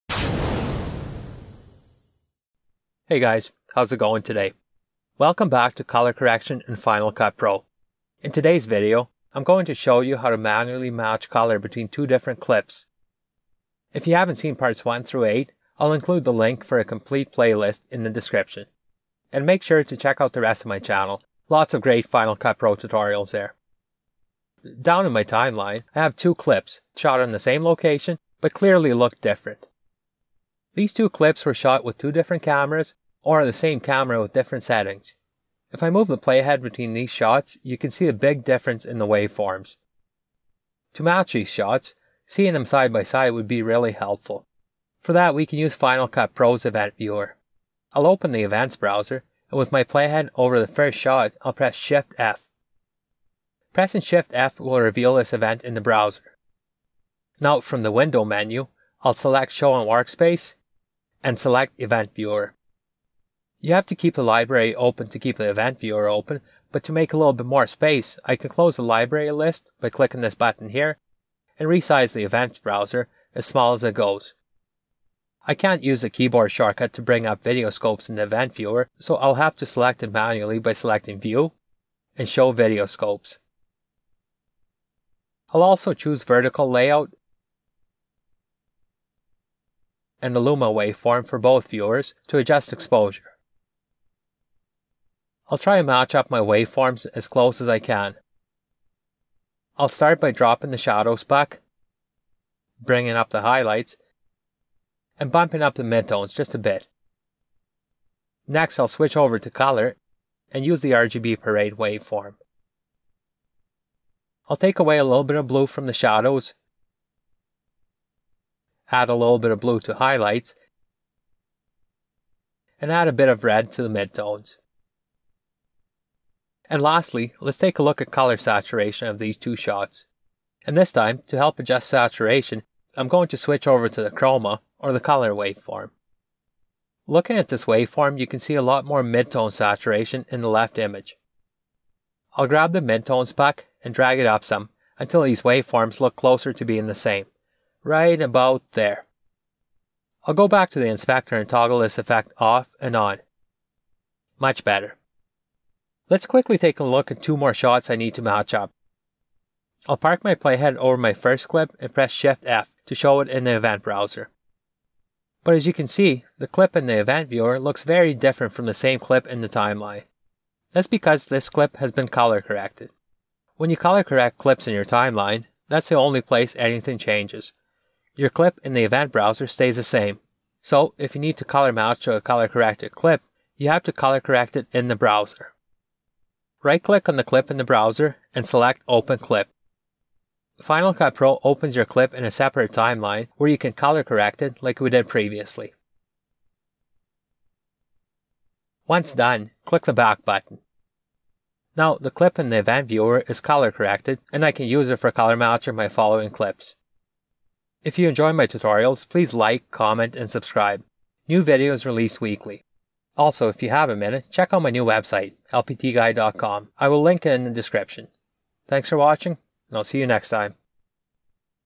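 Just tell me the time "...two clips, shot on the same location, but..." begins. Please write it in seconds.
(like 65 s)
26 s.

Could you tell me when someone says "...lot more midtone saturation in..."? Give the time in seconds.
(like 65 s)
138 s.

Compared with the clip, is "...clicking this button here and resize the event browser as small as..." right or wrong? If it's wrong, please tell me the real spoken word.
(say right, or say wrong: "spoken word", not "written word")
right.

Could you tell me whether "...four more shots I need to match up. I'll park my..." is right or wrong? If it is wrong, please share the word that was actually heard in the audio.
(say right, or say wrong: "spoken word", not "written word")
wrong: "two", not "four".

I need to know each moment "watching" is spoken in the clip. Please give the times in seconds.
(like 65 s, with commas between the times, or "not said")
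218 s.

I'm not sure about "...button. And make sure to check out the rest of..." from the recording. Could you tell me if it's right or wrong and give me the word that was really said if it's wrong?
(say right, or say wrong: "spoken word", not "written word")
wrong: "description", not "button".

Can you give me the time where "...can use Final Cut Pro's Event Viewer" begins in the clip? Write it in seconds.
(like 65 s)
45 s.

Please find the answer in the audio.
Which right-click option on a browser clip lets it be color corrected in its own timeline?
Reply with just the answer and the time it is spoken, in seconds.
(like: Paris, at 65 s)
Open Clip, at 188 s.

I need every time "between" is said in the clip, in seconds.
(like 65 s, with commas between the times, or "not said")
11 s, 36 s.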